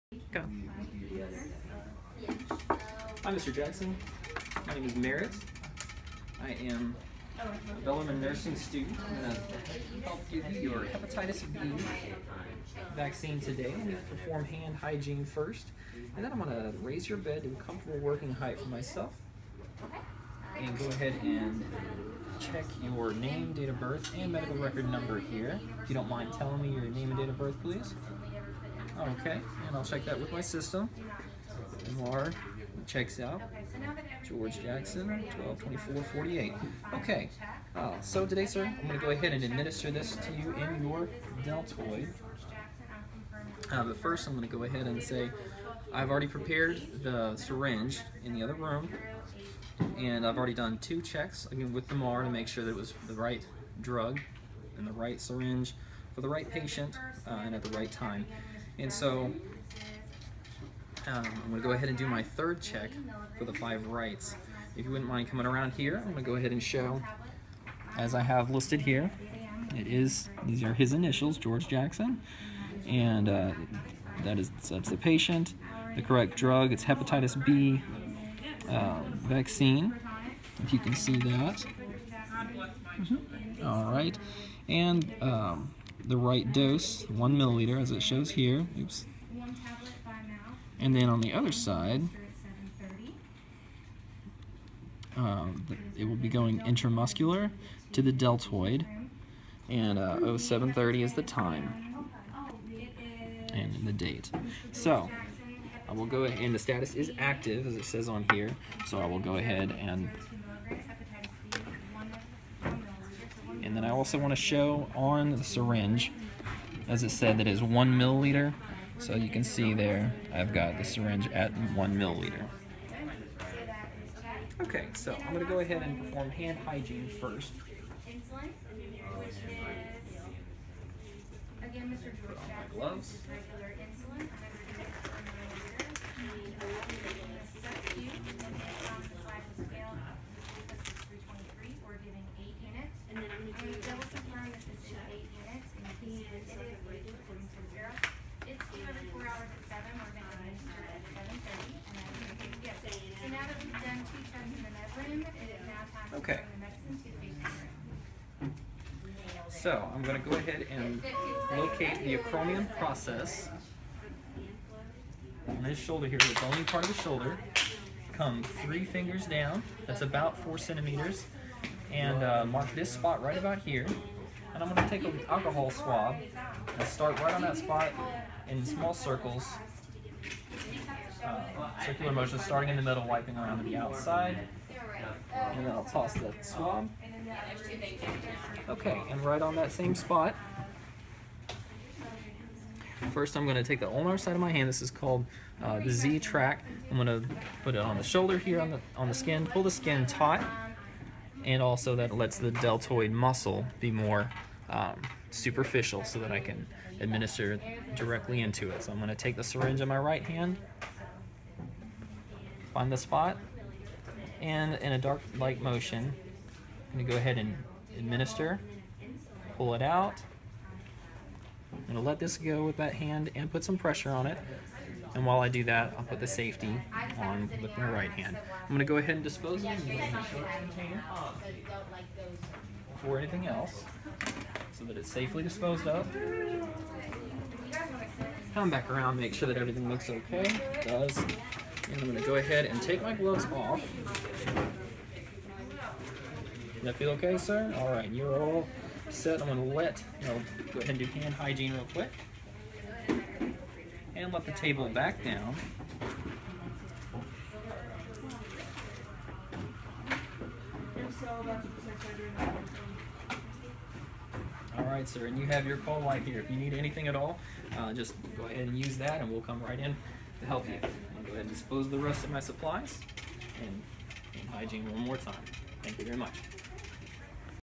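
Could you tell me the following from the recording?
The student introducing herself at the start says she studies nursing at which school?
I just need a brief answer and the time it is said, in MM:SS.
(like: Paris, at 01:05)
Belmont, at 00:07.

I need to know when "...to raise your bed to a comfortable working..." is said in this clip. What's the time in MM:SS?
00:16.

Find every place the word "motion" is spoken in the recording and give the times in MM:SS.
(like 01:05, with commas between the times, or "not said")
03:02, 03:35.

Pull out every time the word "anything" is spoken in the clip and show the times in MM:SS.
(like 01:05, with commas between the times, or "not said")
03:53, 04:26.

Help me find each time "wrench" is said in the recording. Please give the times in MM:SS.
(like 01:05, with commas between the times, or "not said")
not said.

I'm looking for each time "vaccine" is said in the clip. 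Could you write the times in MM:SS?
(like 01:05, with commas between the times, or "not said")
00:12, 01:19.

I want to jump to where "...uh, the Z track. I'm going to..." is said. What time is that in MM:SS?
03:15.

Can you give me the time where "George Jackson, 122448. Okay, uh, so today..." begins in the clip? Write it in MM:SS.
00:34.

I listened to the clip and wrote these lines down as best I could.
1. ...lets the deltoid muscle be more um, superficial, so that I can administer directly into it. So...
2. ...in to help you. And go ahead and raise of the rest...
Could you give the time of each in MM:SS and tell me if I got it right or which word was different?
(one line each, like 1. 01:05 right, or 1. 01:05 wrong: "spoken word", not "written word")
1. 03:22 right
2. 04:29 wrong: "dispose", not "raise".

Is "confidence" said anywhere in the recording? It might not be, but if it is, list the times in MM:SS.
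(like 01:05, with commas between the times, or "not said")
not said.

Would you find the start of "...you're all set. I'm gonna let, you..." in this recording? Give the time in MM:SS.
04:08.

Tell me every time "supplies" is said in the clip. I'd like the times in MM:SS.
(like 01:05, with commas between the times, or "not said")
04:32.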